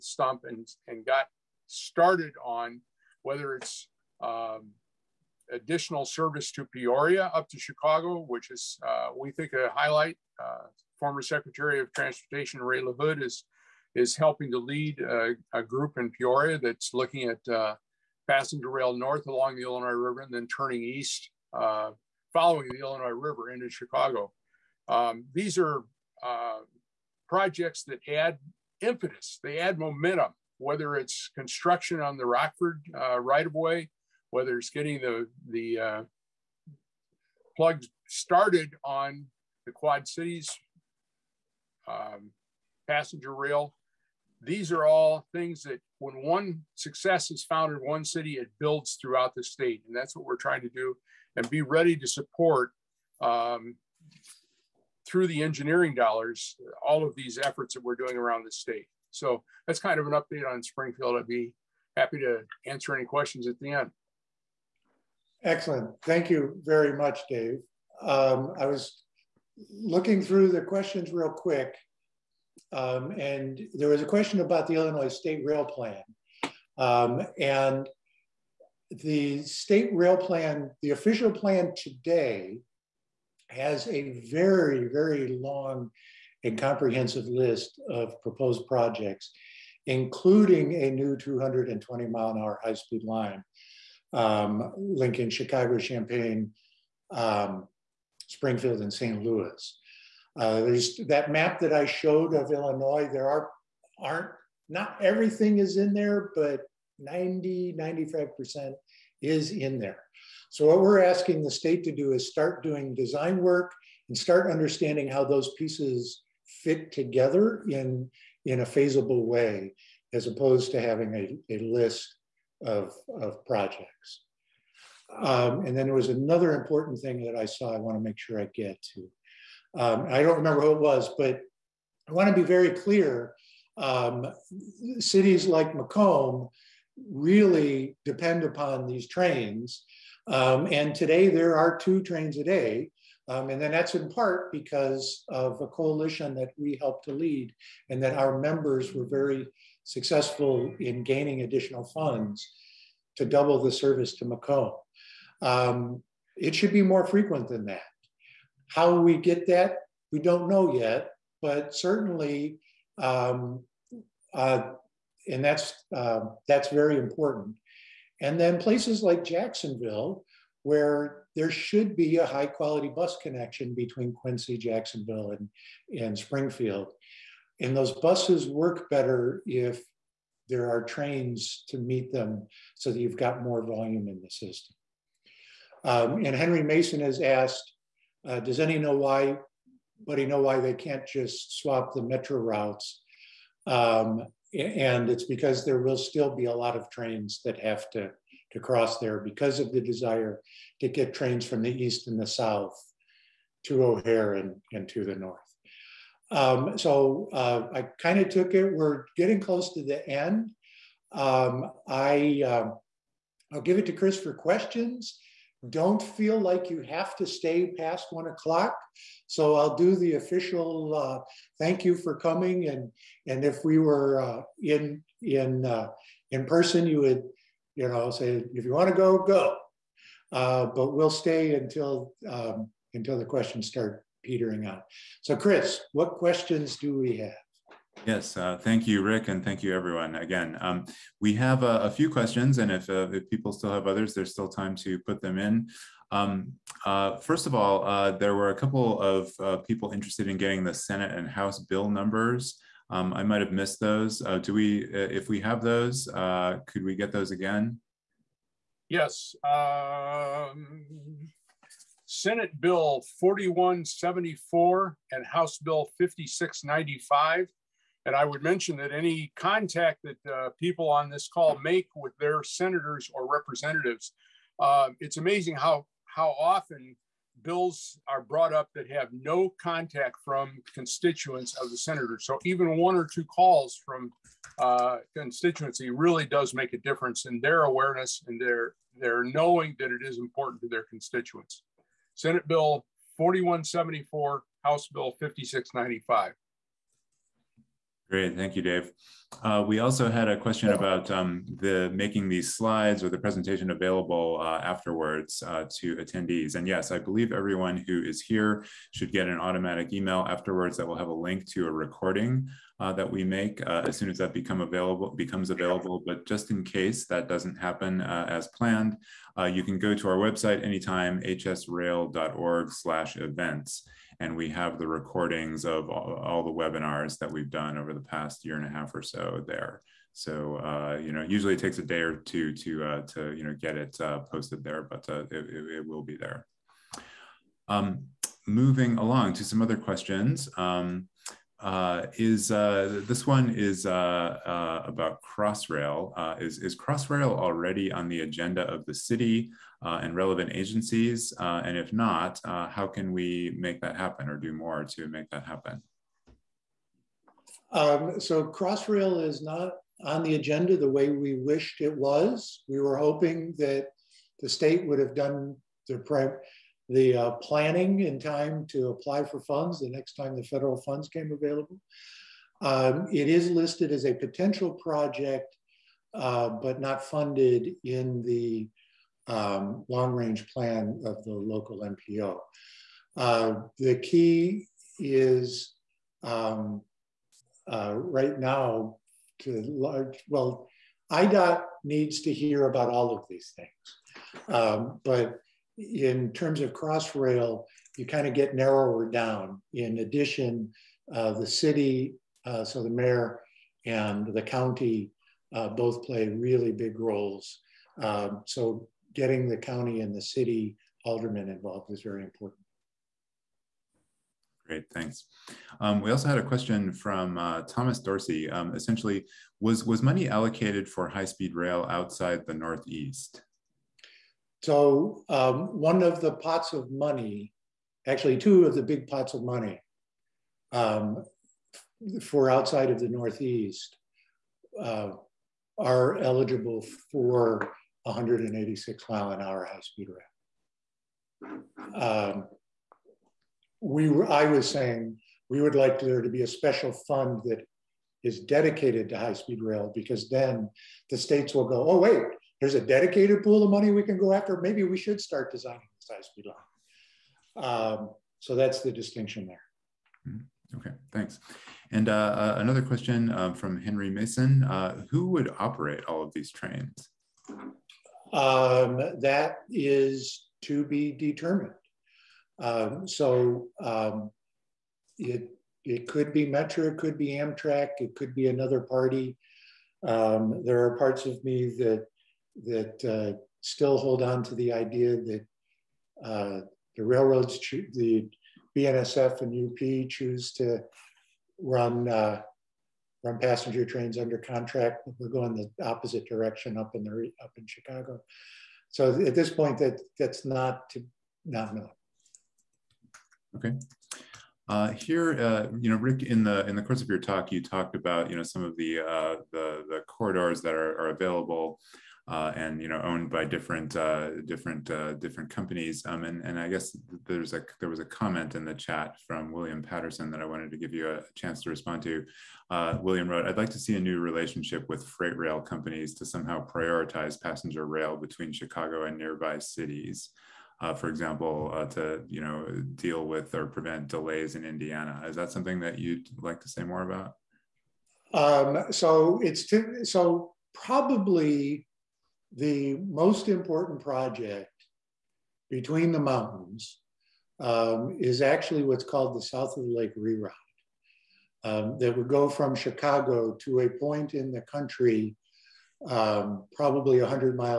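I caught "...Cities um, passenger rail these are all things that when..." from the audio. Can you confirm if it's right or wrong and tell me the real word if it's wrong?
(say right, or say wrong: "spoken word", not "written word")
right.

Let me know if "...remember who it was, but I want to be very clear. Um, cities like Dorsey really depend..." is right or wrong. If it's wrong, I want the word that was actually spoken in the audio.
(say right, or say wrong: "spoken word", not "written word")
wrong: "Macomb", not "Dorsey".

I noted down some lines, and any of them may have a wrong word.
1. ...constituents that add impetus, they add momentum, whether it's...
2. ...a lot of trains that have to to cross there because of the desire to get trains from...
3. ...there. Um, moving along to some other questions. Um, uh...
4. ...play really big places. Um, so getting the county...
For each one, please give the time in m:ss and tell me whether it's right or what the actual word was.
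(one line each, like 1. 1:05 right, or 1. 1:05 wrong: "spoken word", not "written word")
1. 0:27 wrong: "projects", not "constituents"
2. 3:16 right
3. 5:36 right
4. 6:46 wrong: "roles", not "places".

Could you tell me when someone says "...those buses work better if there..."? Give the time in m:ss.
2:57.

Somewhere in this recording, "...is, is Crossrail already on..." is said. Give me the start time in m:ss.
5:46.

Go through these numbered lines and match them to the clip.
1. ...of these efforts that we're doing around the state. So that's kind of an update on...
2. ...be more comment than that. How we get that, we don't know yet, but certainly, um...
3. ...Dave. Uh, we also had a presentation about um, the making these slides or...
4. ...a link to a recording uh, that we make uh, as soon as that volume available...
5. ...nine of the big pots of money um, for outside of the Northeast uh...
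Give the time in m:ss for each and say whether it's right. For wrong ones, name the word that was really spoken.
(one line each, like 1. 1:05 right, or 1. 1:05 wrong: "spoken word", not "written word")
1. 0:57 right
2. 2:36 wrong: "frequent", not "comment"
3. 4:58 wrong: "question", not "presentation"
4. 5:11 wrong: "become", not "volume"
5. 7:08 wrong: "two", not "nine".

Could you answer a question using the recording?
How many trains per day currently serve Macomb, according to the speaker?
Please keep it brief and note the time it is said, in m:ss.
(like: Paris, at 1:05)
2, at 2:21.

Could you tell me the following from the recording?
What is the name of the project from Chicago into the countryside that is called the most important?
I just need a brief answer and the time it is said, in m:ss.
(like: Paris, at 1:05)
South of the Lake Reroute, at 9:09.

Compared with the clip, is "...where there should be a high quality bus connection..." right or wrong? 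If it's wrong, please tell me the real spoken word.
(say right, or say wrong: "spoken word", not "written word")
right.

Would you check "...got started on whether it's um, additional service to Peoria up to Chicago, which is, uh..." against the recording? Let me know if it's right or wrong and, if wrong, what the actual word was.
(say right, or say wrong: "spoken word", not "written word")
right.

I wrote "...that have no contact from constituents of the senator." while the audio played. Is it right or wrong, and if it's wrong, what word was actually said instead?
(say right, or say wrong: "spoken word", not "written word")
right.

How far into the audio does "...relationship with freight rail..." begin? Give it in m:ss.
8:44.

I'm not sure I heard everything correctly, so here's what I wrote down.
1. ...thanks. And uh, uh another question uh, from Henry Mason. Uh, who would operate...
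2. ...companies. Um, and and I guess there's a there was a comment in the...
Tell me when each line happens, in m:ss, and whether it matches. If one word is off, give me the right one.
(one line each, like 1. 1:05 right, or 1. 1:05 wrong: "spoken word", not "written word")
1. 7:41 right
2. 8:35 right.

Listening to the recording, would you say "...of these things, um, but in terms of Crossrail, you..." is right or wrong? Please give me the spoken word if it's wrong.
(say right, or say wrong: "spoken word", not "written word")
right.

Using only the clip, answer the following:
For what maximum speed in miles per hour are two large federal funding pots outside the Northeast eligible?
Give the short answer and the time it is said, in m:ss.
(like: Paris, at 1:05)
186, at 7:18.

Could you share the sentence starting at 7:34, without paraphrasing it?
Maybe we should start designing this high-speed line.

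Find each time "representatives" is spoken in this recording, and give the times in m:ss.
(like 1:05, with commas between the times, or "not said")
4:33.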